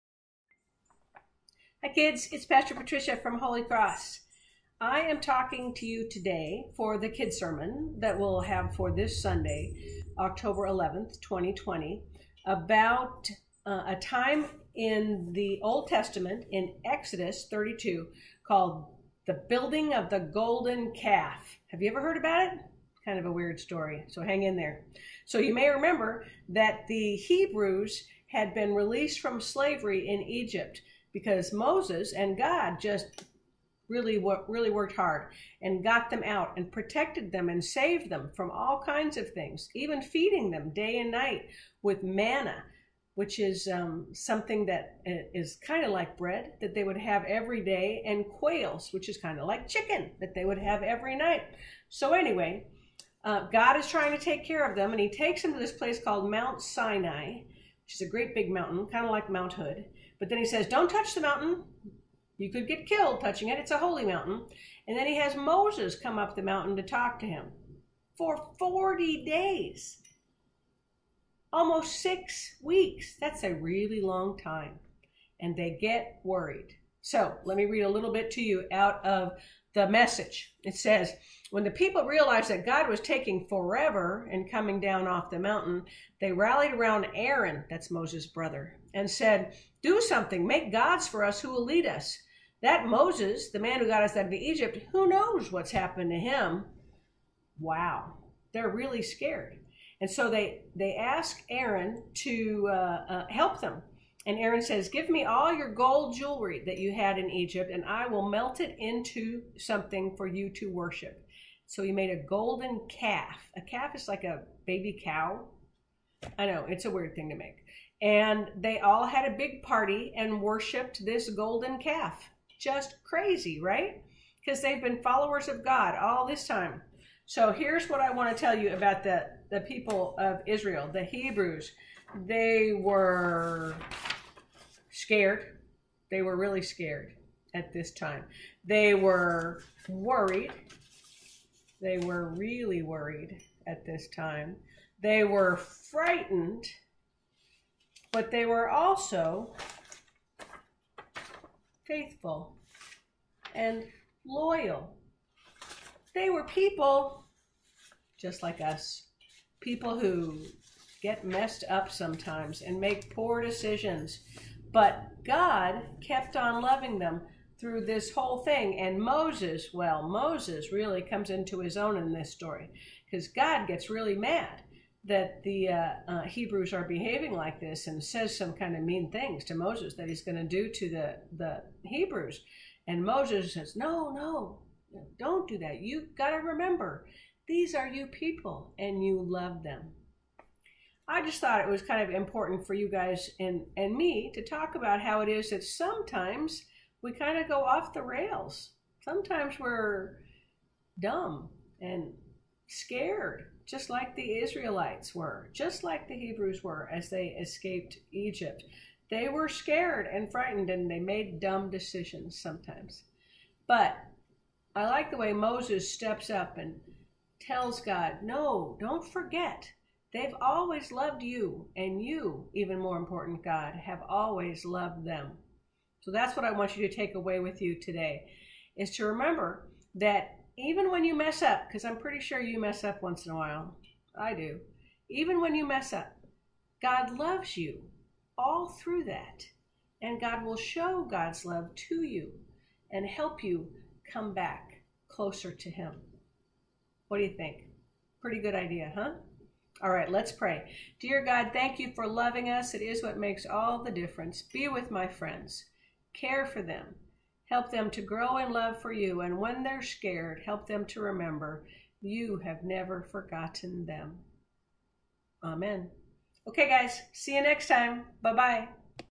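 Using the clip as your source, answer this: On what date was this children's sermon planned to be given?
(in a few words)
October 11th, 2020.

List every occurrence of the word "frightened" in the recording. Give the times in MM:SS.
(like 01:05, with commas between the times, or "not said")
02:25, 03:30.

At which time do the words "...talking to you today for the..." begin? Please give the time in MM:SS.
00:05.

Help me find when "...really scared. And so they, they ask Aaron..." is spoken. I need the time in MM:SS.
01:38.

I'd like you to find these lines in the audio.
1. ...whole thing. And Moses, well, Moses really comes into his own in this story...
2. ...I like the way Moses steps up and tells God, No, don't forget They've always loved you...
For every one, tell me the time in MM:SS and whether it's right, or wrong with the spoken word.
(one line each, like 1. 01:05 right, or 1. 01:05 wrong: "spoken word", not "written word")
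1. 02:48 right
2. 03:34 right.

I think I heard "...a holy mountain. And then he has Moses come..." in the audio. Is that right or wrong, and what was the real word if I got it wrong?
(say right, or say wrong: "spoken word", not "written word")
right.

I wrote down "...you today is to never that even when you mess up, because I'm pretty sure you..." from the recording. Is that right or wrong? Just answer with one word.
wrong.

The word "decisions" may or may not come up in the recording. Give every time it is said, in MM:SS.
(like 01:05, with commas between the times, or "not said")
02:43, 03:31.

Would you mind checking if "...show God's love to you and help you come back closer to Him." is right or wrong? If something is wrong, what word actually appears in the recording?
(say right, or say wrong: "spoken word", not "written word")
right.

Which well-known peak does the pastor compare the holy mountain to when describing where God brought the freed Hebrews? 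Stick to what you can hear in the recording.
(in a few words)
Mount Hood.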